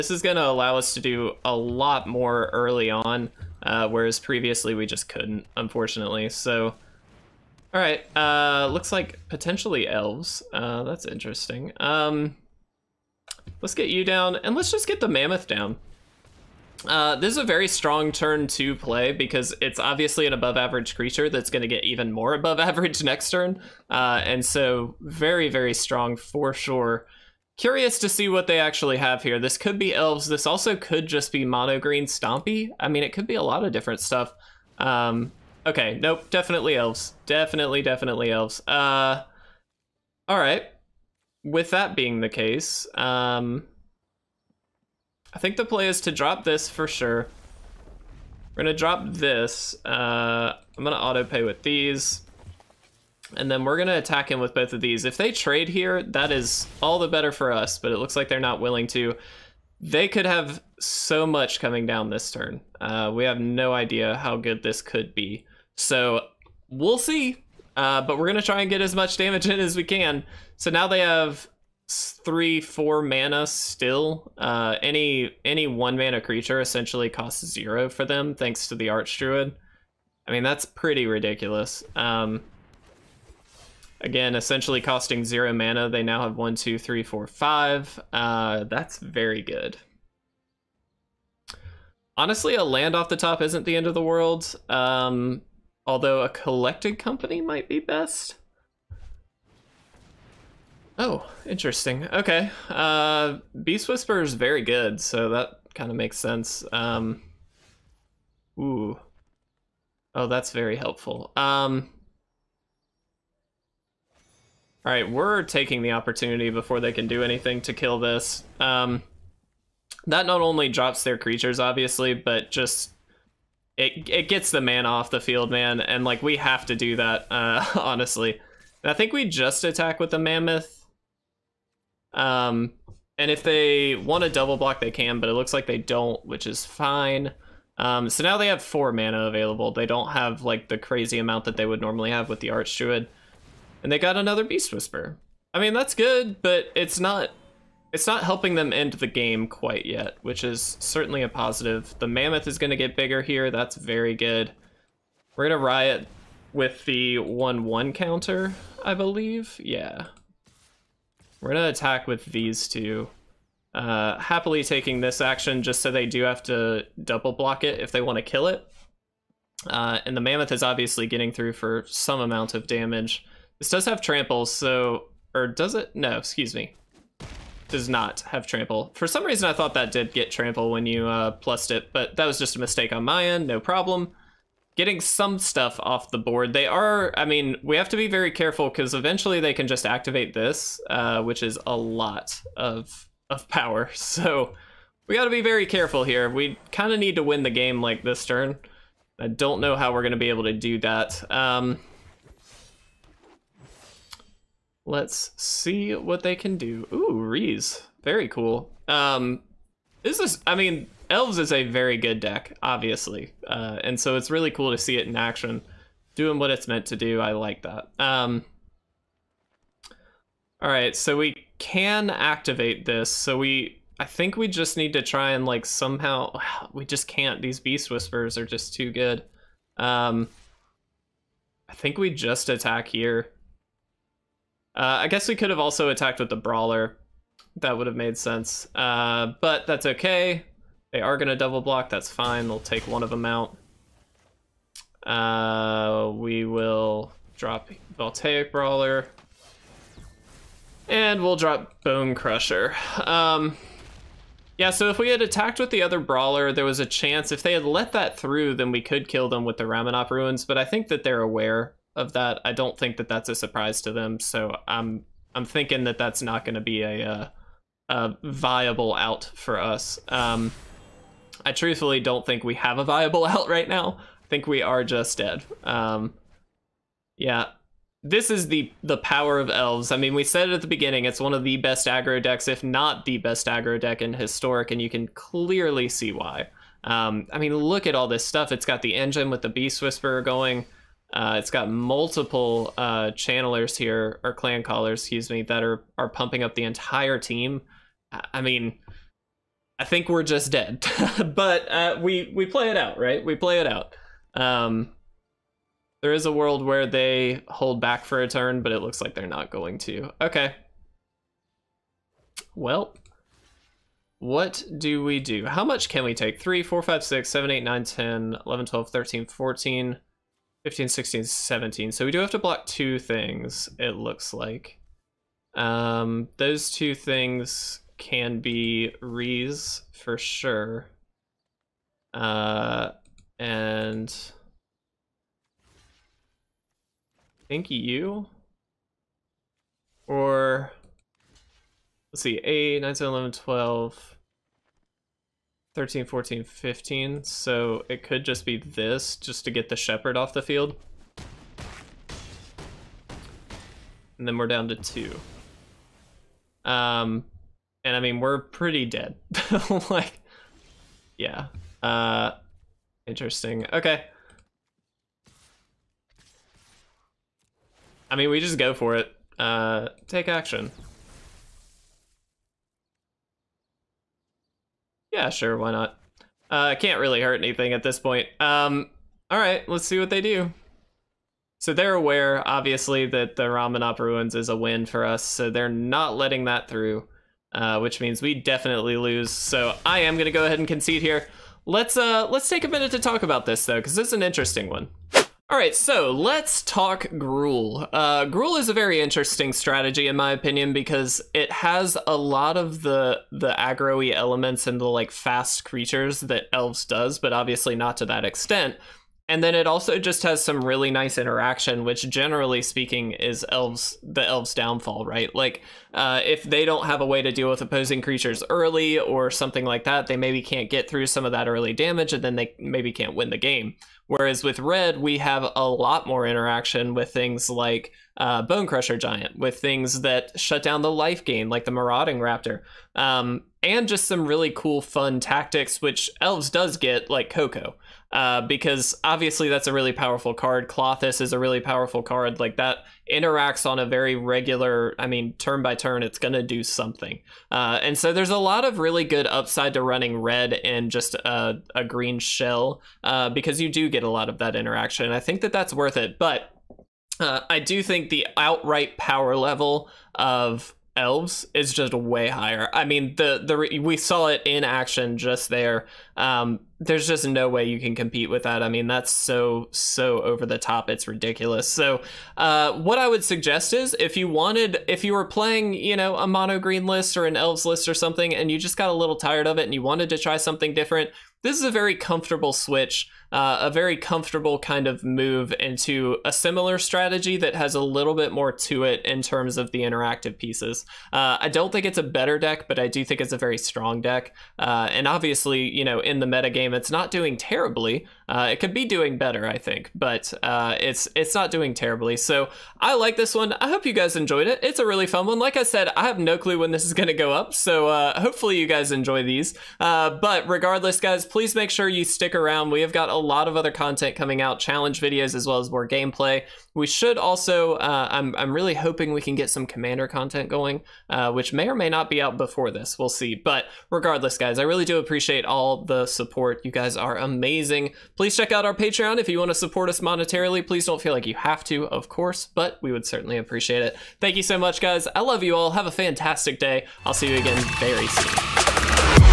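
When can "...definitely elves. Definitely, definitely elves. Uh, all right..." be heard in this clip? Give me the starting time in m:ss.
0:36.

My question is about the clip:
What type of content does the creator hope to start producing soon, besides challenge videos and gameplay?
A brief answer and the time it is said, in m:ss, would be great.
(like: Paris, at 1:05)
Commander content, at 8:39.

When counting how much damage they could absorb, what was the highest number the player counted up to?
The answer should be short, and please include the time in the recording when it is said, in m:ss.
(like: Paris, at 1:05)
17, at 5:21.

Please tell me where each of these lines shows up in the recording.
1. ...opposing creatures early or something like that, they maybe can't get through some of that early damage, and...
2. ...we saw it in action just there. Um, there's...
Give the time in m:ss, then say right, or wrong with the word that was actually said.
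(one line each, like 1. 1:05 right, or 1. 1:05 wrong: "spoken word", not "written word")
1. 6:57 right
2. 7:43 right.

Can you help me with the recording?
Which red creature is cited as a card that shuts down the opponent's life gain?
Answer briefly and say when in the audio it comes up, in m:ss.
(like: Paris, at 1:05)
Marauding Raptor, at 7:11.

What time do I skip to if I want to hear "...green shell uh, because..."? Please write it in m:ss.
7:31.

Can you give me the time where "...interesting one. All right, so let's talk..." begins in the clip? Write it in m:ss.
6:34.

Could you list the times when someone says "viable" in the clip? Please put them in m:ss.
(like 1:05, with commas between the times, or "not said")
4:28, 4:32.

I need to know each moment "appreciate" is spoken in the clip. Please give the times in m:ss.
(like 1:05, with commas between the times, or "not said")
8:44, 8:53.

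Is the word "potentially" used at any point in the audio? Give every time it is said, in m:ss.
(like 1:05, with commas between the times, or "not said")
0:09.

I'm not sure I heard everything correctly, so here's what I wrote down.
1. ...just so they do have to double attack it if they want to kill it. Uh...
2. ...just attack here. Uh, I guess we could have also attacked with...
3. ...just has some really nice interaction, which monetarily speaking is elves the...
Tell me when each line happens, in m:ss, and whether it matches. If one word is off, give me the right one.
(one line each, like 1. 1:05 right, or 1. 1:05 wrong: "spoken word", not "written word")
1. 2:45 wrong: "block", not "attack"
2. 3:52 right
3. 6:49 wrong: "generally", not "monetarily".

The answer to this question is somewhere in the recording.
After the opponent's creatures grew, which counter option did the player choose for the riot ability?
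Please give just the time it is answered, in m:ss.
2:37.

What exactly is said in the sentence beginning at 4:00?
They are going to double block.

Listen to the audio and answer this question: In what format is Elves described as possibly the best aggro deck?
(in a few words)
Historic.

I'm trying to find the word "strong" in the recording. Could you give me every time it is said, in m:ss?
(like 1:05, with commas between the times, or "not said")
0:17, 0:25, 8:13.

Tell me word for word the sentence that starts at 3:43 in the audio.
So we, I think we just need to try and like somehow.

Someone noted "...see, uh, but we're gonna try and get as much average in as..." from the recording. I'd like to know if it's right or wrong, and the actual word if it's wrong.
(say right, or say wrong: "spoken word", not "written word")
wrong: "damage", not "average".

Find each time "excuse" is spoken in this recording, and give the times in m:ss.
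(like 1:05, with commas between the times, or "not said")
2:56, 4:55.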